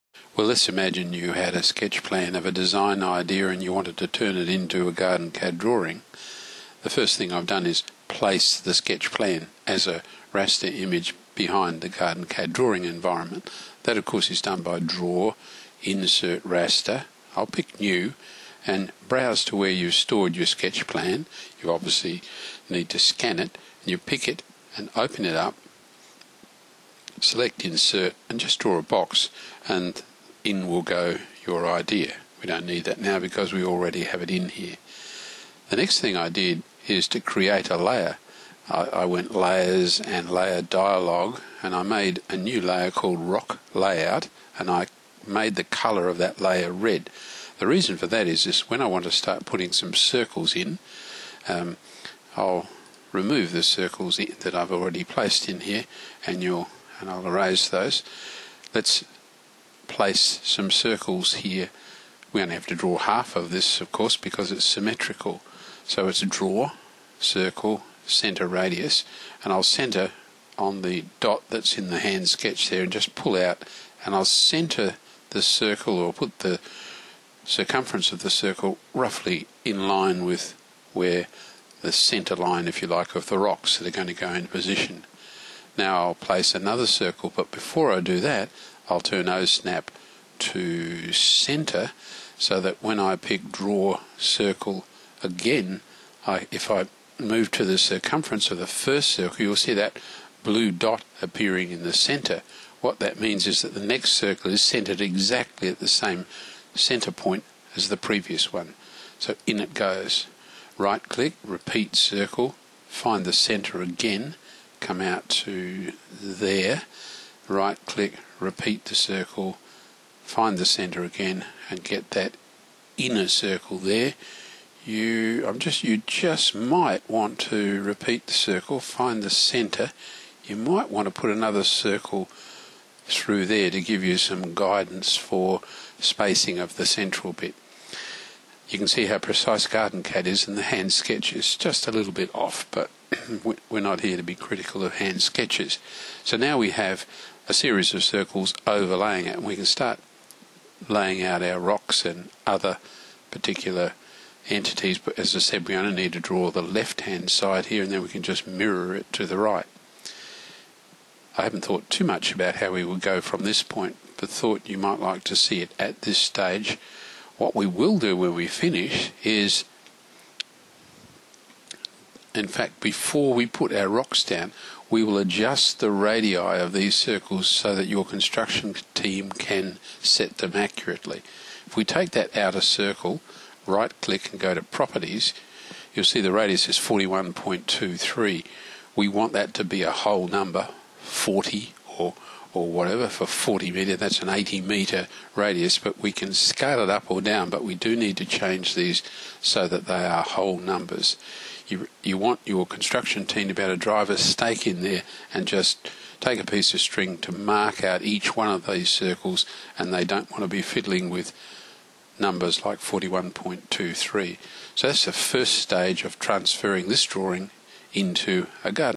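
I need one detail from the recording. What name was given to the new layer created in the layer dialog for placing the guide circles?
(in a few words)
rock layout.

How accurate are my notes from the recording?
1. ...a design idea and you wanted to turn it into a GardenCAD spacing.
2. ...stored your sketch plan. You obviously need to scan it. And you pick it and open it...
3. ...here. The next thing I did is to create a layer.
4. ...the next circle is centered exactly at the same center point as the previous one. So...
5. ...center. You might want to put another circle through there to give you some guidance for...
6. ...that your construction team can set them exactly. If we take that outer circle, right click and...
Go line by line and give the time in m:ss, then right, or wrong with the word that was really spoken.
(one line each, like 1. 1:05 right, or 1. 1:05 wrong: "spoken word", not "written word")
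1. 0:02 wrong: "drawing", not "spacing"
2. 0:19 right
3. 0:34 right
4. 1:43 right
5. 2:09 right
6. 2:57 wrong: "accurately", not "exactly".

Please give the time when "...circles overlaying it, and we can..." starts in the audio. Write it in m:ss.
2:28.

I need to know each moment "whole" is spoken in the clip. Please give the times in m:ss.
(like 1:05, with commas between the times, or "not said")
3:09, 3:20.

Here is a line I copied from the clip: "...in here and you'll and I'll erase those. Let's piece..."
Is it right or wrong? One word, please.
wrong.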